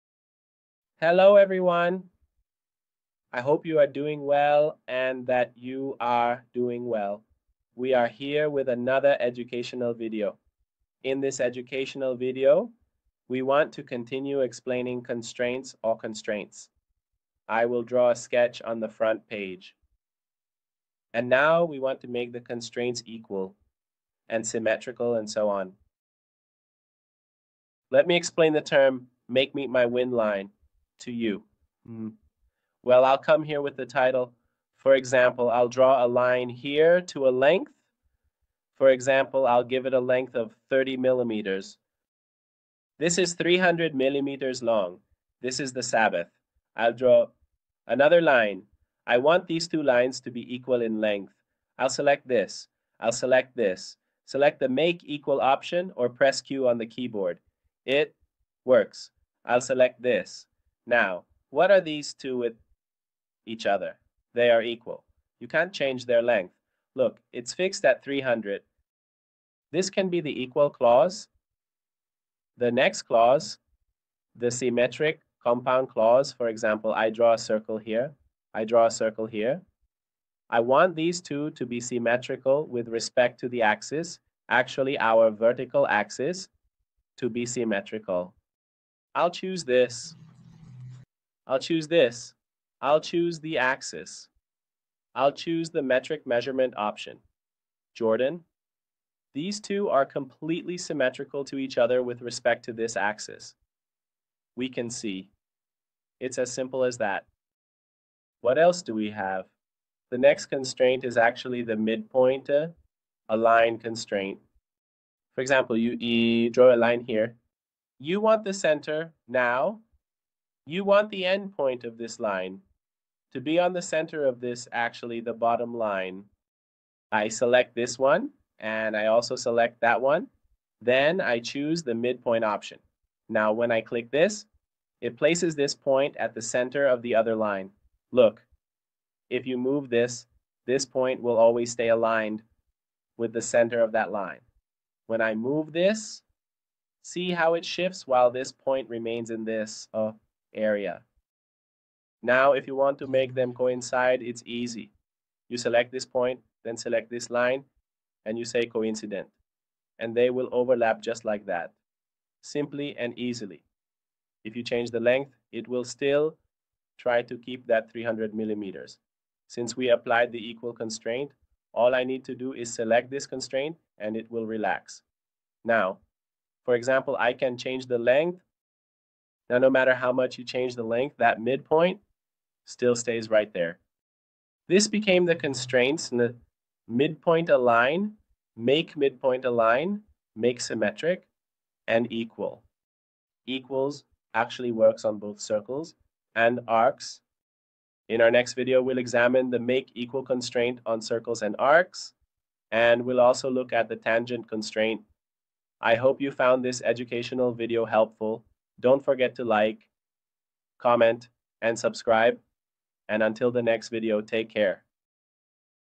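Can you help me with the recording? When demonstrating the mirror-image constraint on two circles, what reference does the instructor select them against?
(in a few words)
vertical axis.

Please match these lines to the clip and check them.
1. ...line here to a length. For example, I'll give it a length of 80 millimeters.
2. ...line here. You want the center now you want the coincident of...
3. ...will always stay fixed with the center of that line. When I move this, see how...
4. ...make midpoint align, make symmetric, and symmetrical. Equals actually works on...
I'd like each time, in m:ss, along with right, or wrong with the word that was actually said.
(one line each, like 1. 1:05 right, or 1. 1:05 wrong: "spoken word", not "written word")
1. 0:36 wrong: "30", not "80"
2. 1:56 wrong: "endpoint", not "coincident"
3. 2:21 wrong: "aligned", not "fixed"
4. 3:08 wrong: "equal", not "symmetrical".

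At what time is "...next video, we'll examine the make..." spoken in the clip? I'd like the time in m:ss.
3:18.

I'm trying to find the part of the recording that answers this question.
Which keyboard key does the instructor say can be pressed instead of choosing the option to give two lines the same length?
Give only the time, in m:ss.
0:56.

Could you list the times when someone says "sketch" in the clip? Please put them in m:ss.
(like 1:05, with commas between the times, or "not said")
0:18.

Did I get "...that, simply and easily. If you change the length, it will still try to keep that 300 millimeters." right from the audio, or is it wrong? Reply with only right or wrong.
right.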